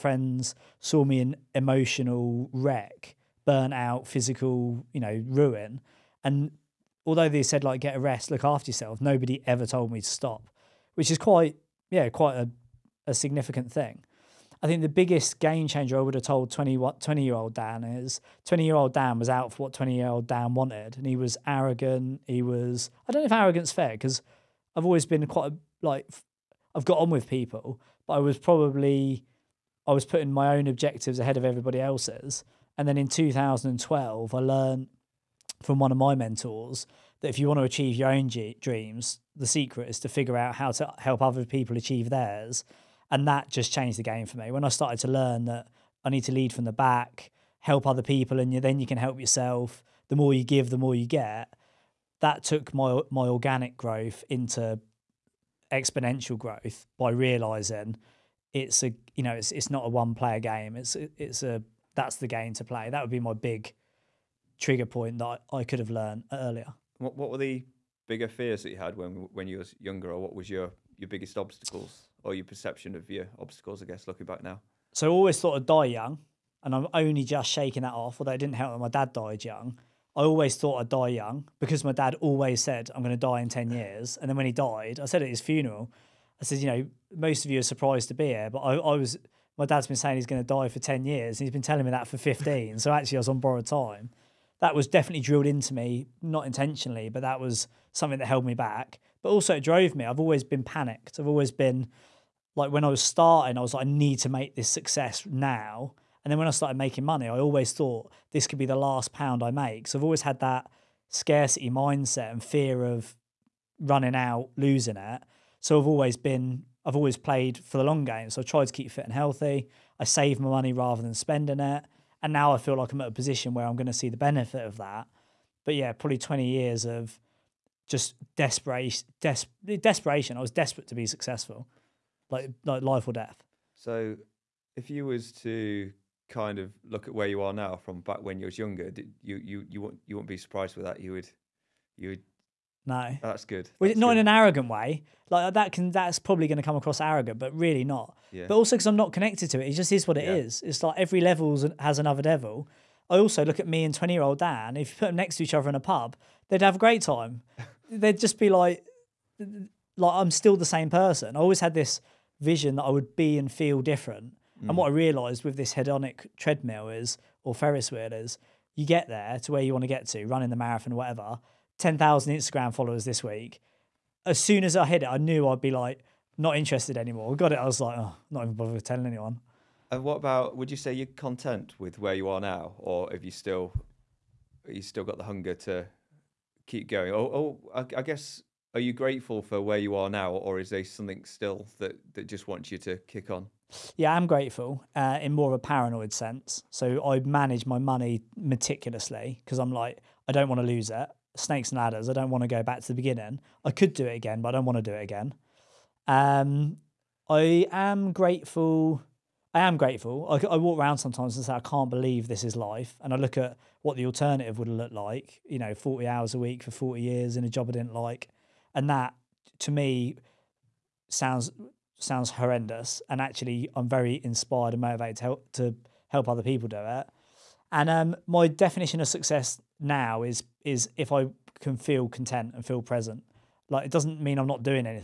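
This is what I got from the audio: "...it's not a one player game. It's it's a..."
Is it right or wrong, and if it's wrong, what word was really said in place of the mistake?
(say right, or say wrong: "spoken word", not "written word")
right.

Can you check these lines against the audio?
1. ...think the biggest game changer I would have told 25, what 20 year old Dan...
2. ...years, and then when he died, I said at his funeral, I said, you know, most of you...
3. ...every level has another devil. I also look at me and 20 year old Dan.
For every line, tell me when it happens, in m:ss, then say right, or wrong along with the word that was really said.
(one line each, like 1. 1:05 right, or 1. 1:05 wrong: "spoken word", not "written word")
1. 0:14 wrong: "20", not "25"
2. 1:23 right
3. 2:30 right.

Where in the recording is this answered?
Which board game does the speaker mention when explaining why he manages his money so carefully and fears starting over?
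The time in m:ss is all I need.
3:21.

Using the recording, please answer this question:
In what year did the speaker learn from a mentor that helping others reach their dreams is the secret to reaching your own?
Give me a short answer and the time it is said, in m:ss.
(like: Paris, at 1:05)
2012, at 0:33.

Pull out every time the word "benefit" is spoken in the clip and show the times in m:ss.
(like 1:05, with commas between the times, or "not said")
2:04.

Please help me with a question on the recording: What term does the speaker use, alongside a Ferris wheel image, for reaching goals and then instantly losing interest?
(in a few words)
hedonic treadmill.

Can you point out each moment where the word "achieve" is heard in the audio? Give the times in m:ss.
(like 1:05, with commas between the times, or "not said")
0:37, 0:41.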